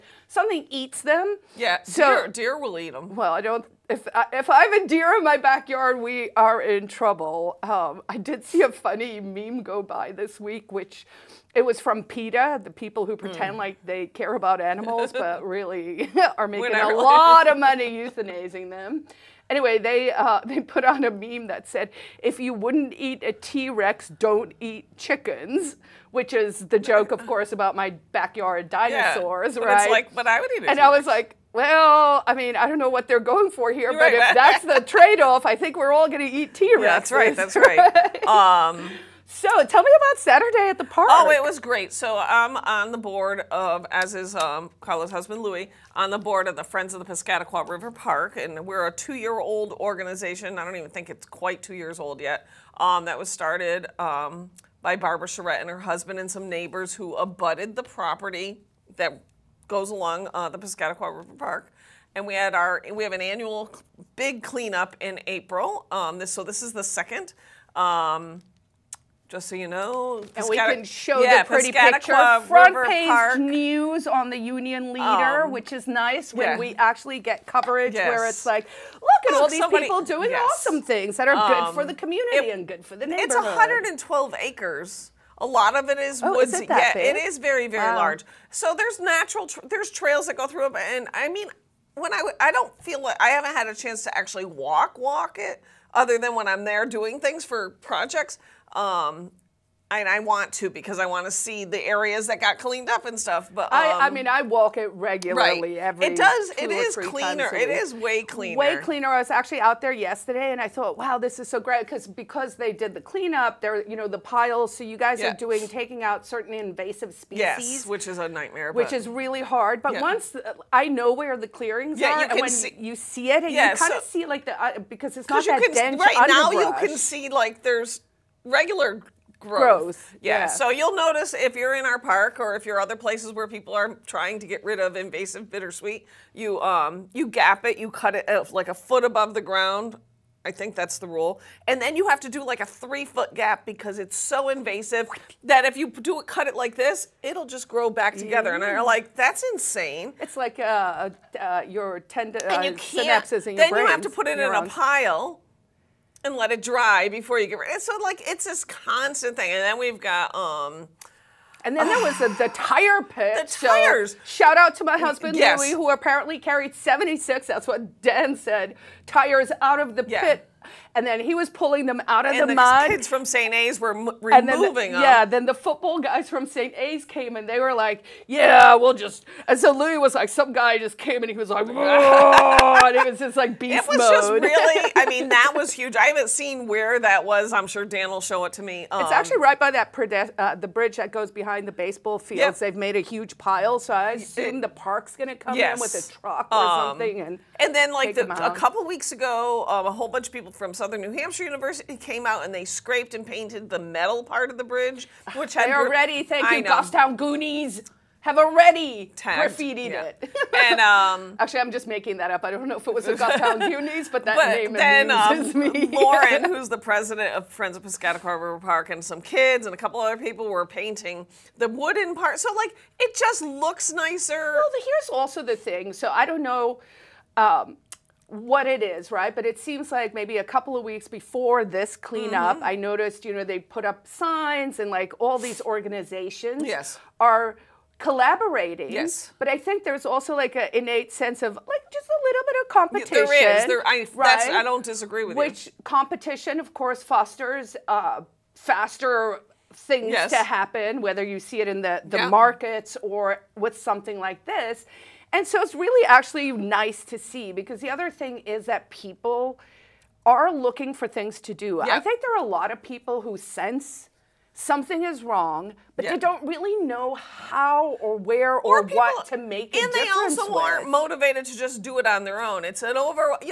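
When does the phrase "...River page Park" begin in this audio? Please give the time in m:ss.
1:12.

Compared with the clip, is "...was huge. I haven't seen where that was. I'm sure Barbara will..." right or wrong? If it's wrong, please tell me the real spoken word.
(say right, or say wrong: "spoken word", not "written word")
wrong: "Dan", not "Barbara".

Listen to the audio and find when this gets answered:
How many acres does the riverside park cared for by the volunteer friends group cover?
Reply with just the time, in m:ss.
1:23.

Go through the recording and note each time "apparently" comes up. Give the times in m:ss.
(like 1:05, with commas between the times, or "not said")
2:45.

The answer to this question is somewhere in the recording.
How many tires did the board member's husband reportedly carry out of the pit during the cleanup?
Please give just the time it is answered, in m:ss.
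2:46.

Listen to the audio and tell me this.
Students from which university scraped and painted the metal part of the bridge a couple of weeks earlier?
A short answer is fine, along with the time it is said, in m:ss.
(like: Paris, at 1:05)
Southern New Hampshire University, at 3:20.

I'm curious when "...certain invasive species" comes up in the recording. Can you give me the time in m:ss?
1:56.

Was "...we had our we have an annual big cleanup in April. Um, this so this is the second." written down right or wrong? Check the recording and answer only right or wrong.
right.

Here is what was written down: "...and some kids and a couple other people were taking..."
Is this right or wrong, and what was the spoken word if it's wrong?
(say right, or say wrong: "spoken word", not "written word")
wrong: "painting", not "taking".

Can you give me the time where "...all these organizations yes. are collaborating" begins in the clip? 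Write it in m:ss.
3:55.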